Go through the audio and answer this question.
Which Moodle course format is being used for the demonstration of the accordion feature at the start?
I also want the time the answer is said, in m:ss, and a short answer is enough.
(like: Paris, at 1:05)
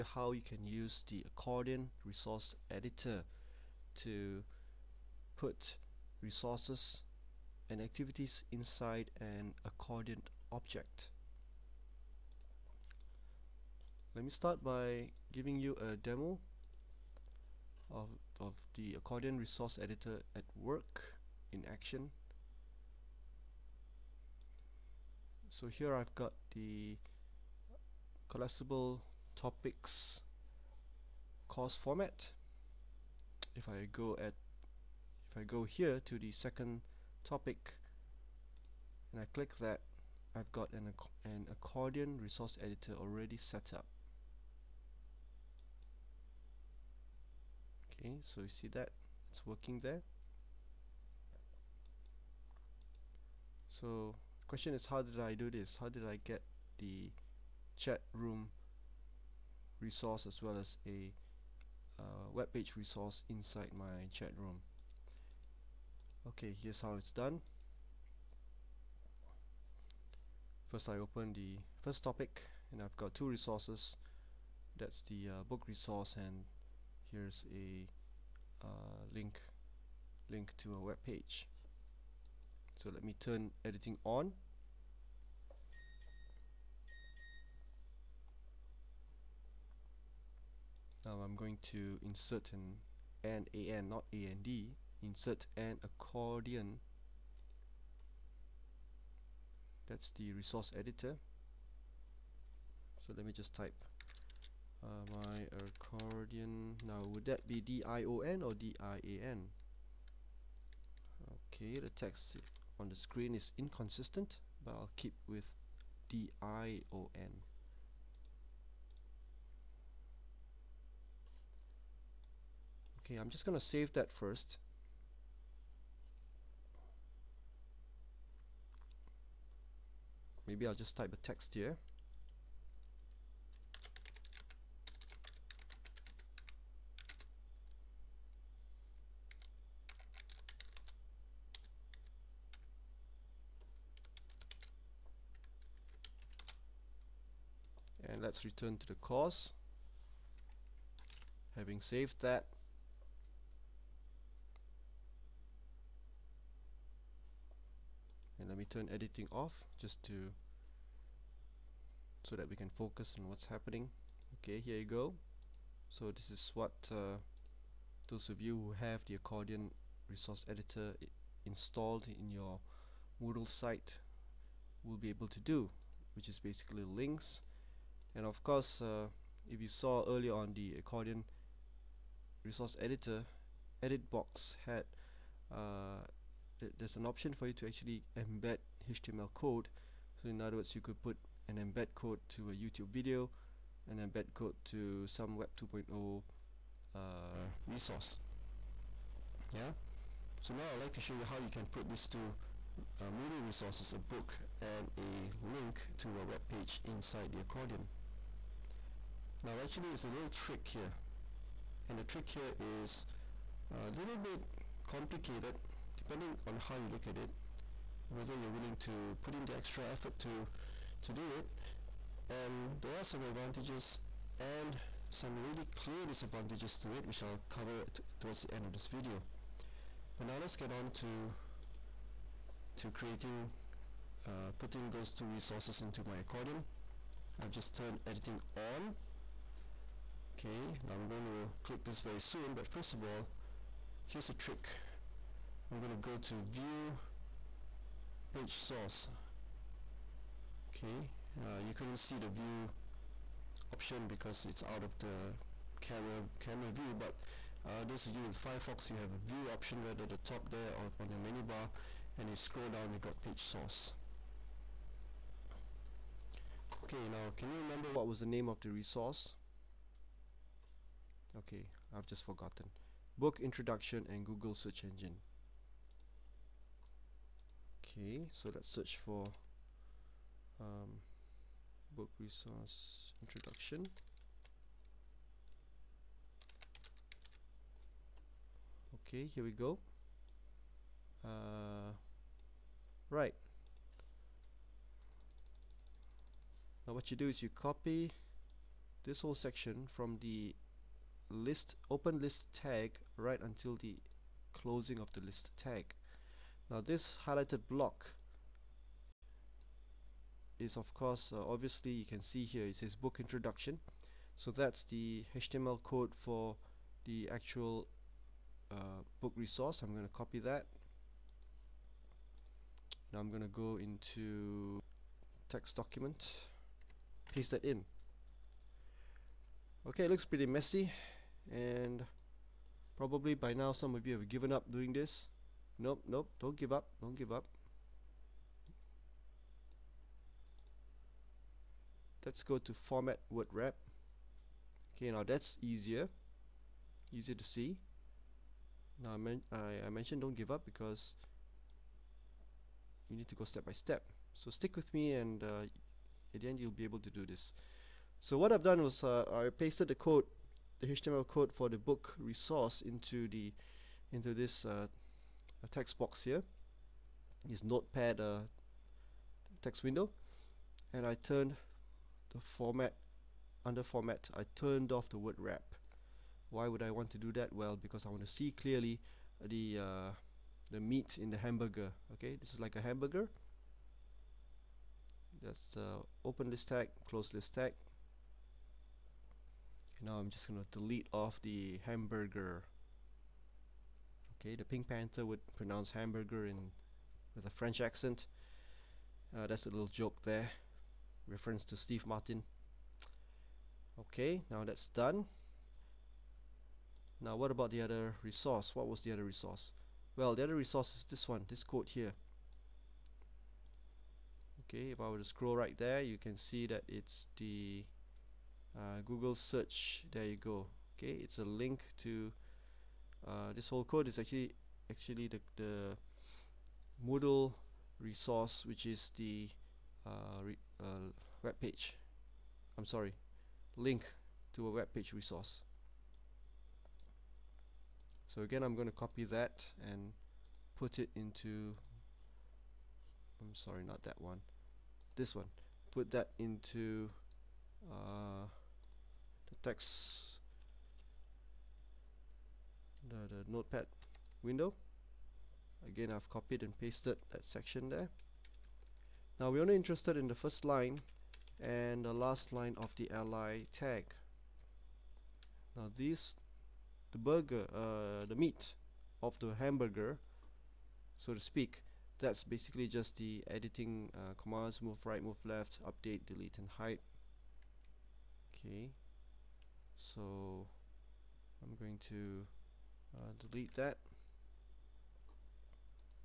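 collapsible topics, at 0:28.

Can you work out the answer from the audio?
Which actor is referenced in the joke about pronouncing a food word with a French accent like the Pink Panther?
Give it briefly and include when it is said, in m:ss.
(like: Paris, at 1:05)
Steve Martin, at 6:41.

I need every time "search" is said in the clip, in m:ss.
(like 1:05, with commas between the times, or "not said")
4:34, 4:38, 6:59.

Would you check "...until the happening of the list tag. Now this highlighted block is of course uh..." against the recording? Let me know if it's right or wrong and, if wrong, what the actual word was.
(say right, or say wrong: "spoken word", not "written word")
wrong: "closing", not "happening".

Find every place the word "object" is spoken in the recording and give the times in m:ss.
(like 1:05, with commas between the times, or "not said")
0:10.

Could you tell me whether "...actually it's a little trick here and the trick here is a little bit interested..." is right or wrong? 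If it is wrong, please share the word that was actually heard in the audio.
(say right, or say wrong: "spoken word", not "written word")
wrong: "complicated", not "interested".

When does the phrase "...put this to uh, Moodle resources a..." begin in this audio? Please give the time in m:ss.
3:21.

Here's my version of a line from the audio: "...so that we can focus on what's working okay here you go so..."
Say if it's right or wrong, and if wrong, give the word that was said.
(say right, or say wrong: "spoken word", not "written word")
wrong: "happening", not "working".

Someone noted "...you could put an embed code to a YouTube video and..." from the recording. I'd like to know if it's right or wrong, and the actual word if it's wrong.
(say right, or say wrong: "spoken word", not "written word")
right.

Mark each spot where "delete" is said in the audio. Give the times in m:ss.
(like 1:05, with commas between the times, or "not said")
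6:30, 7:56, 8:03.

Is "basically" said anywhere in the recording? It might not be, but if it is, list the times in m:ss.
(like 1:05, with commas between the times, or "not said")
2:56, 7:52.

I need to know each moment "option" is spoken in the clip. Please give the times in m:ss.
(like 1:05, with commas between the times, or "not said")
3:07, 4:13, 4:19.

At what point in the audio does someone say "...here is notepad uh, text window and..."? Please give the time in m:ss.
6:06.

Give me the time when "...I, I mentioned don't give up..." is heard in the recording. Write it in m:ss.
5:49.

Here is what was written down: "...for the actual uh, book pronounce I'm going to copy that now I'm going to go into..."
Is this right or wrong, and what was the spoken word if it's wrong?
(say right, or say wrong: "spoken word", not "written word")
wrong: "resource", not "pronounce".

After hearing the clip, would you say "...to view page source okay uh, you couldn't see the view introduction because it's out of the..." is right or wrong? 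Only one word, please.
wrong.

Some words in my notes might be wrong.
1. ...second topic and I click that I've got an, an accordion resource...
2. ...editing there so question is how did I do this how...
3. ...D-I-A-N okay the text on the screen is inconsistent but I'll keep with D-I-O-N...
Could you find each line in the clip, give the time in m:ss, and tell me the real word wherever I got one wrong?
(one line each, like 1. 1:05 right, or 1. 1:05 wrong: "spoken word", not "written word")
1. 0:36 right
2. 0:49 wrong: "working", not "editing"
3. 1:48 right.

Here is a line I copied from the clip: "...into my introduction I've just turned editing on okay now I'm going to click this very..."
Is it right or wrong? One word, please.
wrong.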